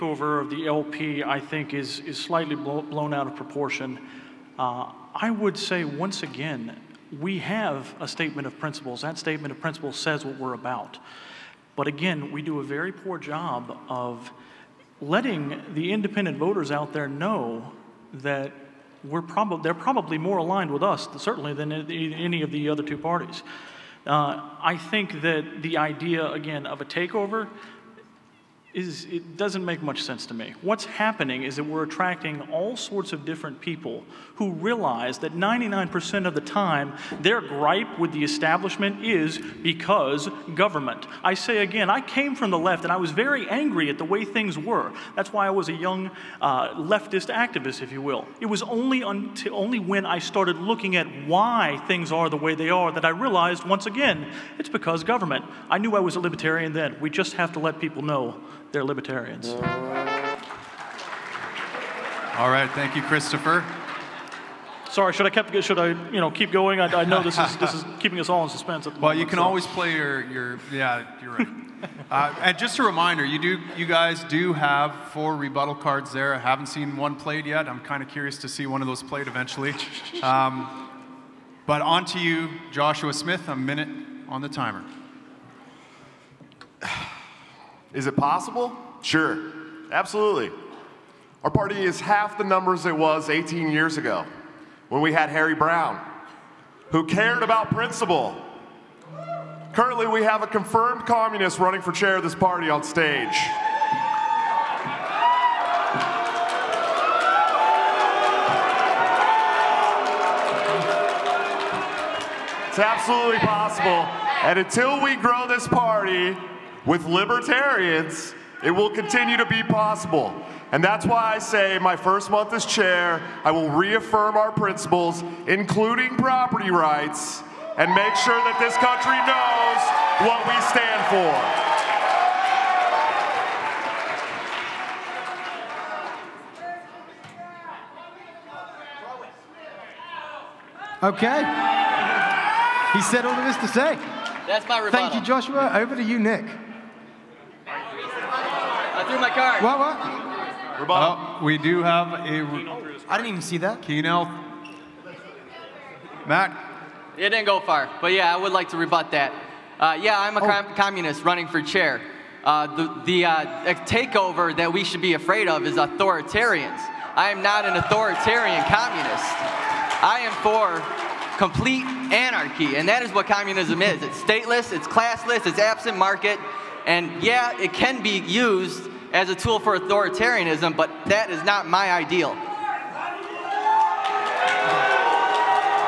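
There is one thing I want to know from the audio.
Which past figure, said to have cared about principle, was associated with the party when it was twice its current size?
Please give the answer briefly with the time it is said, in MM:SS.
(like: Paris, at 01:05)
Harry Browne, at 01:35.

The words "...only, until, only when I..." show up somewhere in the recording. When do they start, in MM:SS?
00:48.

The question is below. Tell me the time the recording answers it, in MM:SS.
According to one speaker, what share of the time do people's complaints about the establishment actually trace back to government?
00:35.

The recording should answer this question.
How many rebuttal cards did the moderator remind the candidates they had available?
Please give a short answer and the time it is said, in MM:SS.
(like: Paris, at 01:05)
4, at 01:15.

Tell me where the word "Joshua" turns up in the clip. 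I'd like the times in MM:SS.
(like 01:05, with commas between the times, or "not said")
01:22, 02:25.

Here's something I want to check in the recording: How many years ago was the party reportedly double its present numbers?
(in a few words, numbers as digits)
18.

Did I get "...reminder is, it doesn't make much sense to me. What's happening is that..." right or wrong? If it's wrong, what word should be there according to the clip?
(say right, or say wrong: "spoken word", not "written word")
wrong: "takeover", not "reminder".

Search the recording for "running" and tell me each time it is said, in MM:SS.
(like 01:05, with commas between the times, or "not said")
01:41, 02:41.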